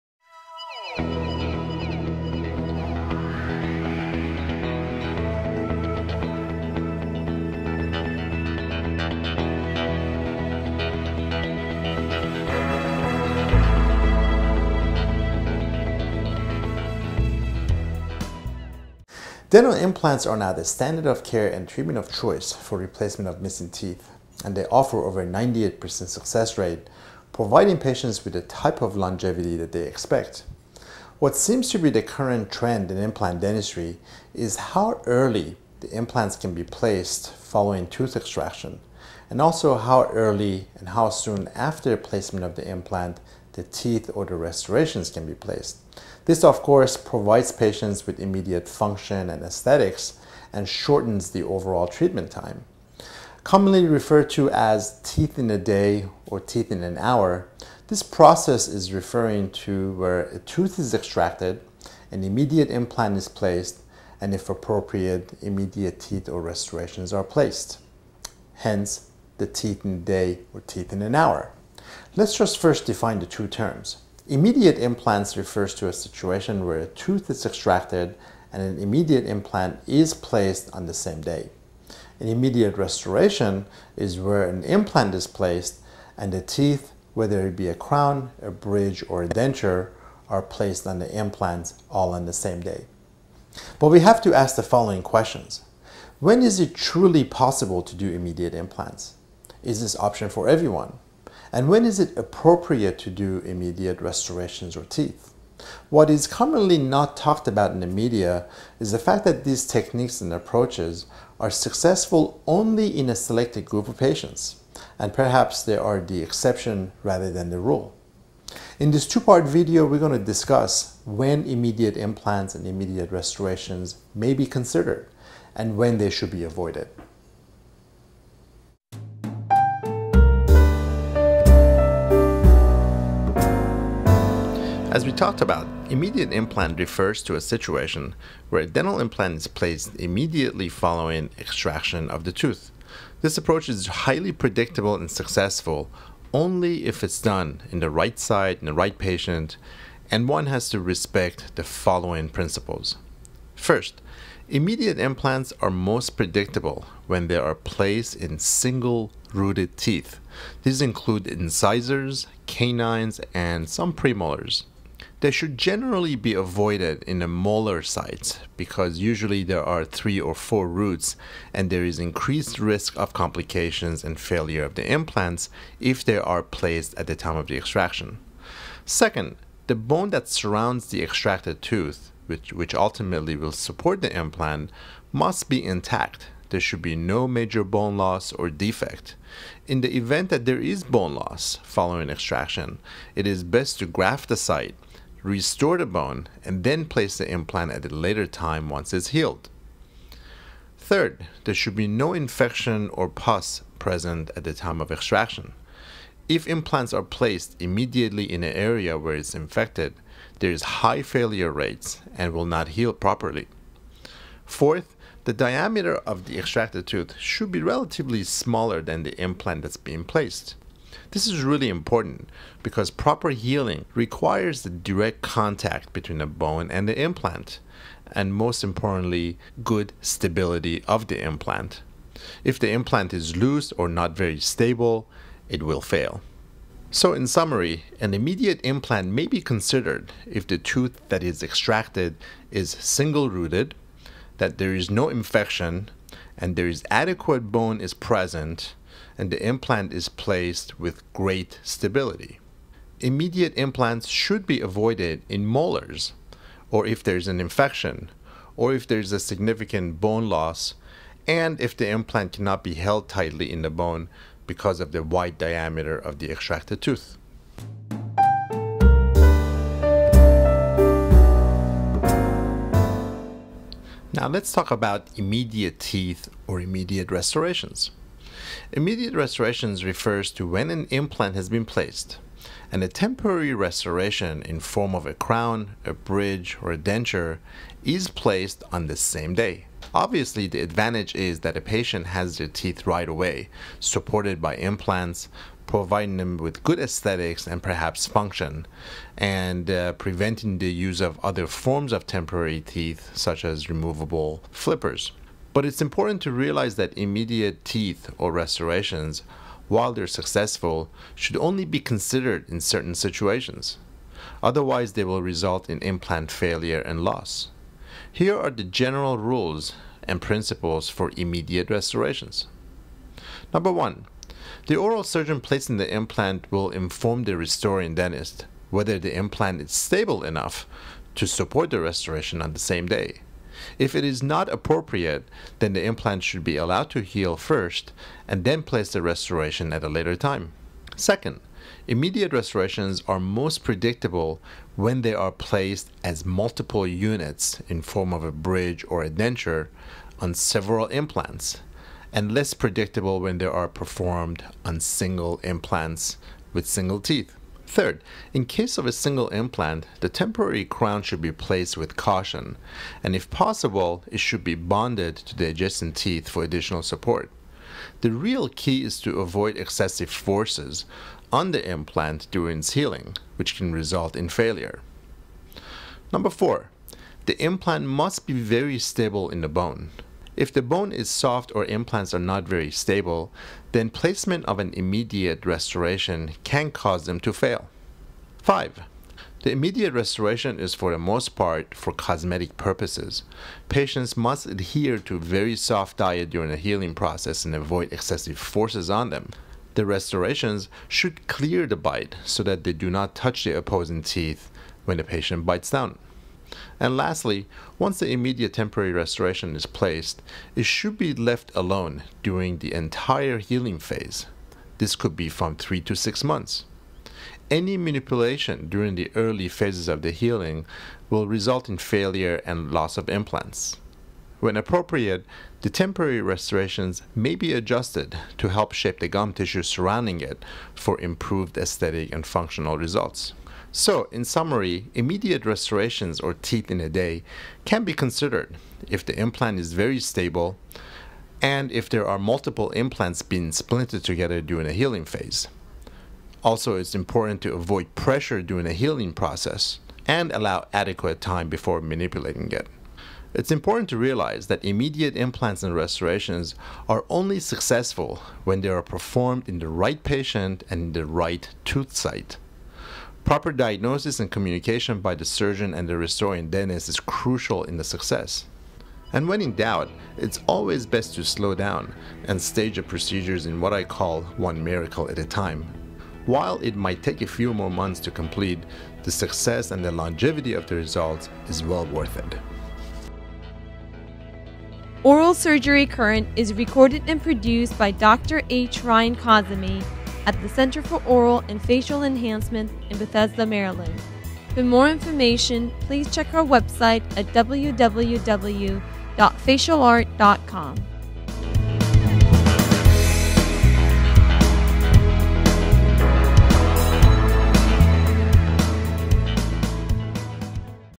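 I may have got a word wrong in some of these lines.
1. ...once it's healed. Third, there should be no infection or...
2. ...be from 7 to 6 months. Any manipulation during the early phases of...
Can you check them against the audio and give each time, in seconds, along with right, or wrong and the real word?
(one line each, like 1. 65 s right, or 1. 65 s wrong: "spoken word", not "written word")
1. 198 s right
2. 415 s wrong: "3", not "7".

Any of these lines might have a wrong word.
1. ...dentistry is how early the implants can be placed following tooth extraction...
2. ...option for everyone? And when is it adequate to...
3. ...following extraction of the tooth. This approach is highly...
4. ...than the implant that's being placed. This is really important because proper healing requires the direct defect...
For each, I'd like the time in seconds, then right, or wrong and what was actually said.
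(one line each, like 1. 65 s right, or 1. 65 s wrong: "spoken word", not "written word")
1. 33 s right
2. 99 s wrong: "appropriate", not "adequate"
3. 140 s right
4. 218 s wrong: "contact", not "defect".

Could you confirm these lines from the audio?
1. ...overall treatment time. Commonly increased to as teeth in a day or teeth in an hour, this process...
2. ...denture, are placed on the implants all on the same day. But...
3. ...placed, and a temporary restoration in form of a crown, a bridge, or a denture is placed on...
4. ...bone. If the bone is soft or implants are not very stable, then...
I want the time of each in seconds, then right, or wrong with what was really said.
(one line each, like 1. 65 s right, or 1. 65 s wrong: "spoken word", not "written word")
1. 51 s wrong: "referred", not "increased"
2. 89 s right
3. 281 s right
4. 379 s right.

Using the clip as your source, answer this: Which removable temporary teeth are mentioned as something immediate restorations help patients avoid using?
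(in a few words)
removable flippers.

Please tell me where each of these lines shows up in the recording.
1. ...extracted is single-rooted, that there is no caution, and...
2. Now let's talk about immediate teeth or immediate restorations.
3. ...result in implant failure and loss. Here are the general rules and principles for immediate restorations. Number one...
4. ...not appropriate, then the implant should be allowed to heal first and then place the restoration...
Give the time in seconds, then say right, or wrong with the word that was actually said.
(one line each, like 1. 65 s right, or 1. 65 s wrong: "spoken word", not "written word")
1. 241 s wrong: "infection", not "caution"
2. 274 s right
3. 315 s right
4. 334 s right.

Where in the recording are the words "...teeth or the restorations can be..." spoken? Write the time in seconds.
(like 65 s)
43 s.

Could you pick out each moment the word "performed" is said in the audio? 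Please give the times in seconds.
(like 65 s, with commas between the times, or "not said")
353 s, 458 s.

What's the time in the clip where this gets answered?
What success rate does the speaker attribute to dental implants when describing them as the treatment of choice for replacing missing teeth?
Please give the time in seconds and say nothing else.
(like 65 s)
25 s.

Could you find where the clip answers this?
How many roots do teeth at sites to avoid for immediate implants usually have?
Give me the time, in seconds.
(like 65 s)
169 s.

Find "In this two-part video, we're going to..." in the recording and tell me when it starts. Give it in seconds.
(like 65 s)
118 s.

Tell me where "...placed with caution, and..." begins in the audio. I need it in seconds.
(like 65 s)
361 s.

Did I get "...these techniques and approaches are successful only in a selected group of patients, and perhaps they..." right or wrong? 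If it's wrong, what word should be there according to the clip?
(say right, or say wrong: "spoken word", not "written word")
right.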